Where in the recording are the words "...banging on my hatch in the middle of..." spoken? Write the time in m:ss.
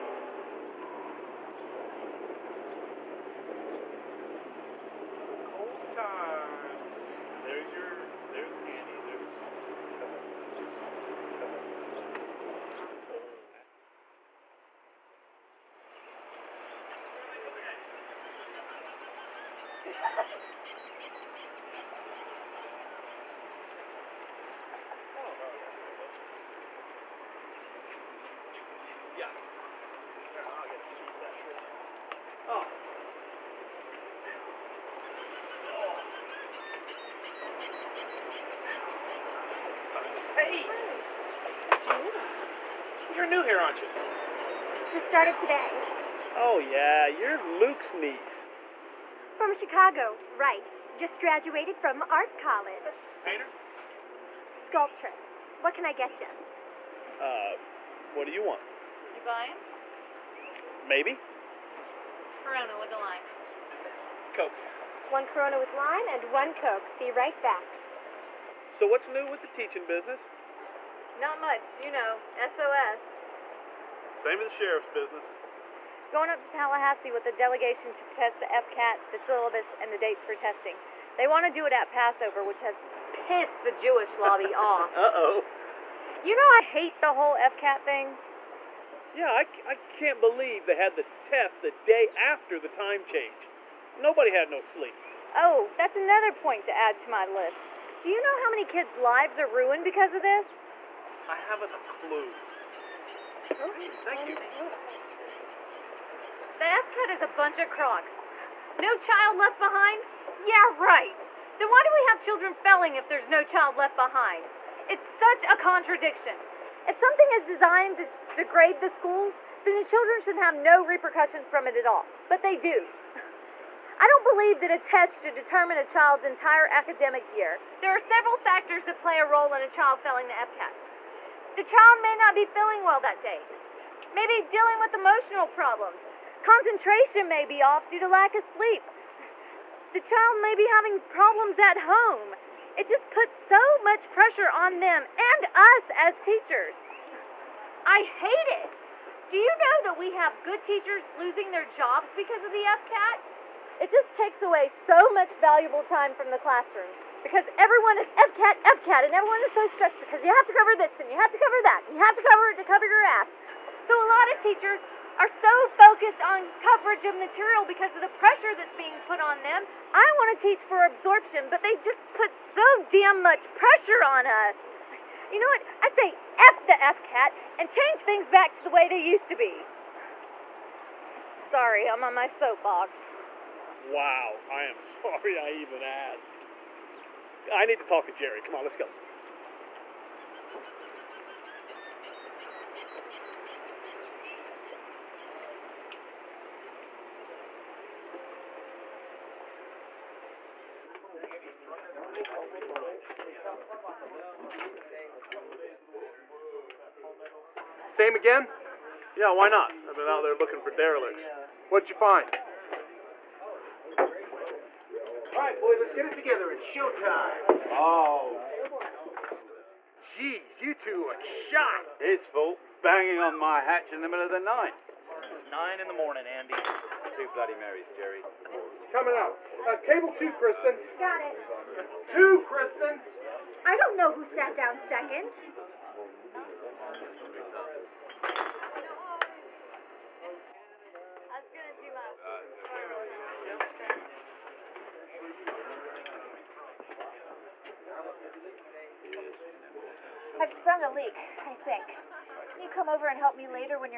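3:42.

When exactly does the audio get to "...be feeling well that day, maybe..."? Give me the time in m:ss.
2:12.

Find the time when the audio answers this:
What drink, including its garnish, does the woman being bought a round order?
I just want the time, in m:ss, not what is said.
1:02.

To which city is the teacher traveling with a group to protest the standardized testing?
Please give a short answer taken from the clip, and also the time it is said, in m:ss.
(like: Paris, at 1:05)
Tallahassee, at 1:16.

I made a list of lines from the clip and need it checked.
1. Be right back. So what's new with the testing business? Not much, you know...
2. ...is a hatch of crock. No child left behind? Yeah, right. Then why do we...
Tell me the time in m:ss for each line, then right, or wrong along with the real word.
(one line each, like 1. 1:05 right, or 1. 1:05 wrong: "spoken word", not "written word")
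1. 1:06 wrong: "teaching", not "testing"
2. 1:47 wrong: "bunch", not "hatch".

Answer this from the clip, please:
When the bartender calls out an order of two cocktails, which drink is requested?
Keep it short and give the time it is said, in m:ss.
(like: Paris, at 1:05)
Bloody Marys, at 3:47.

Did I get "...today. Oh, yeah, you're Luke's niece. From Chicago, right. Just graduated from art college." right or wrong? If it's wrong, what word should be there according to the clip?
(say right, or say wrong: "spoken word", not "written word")
right.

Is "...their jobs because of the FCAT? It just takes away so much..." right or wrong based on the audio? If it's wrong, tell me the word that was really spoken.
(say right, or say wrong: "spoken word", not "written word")
right.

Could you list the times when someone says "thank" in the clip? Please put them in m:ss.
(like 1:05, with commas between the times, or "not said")
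1:44.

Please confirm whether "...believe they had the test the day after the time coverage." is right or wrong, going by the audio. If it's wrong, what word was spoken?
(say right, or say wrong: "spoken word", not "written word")
wrong: "change", not "coverage".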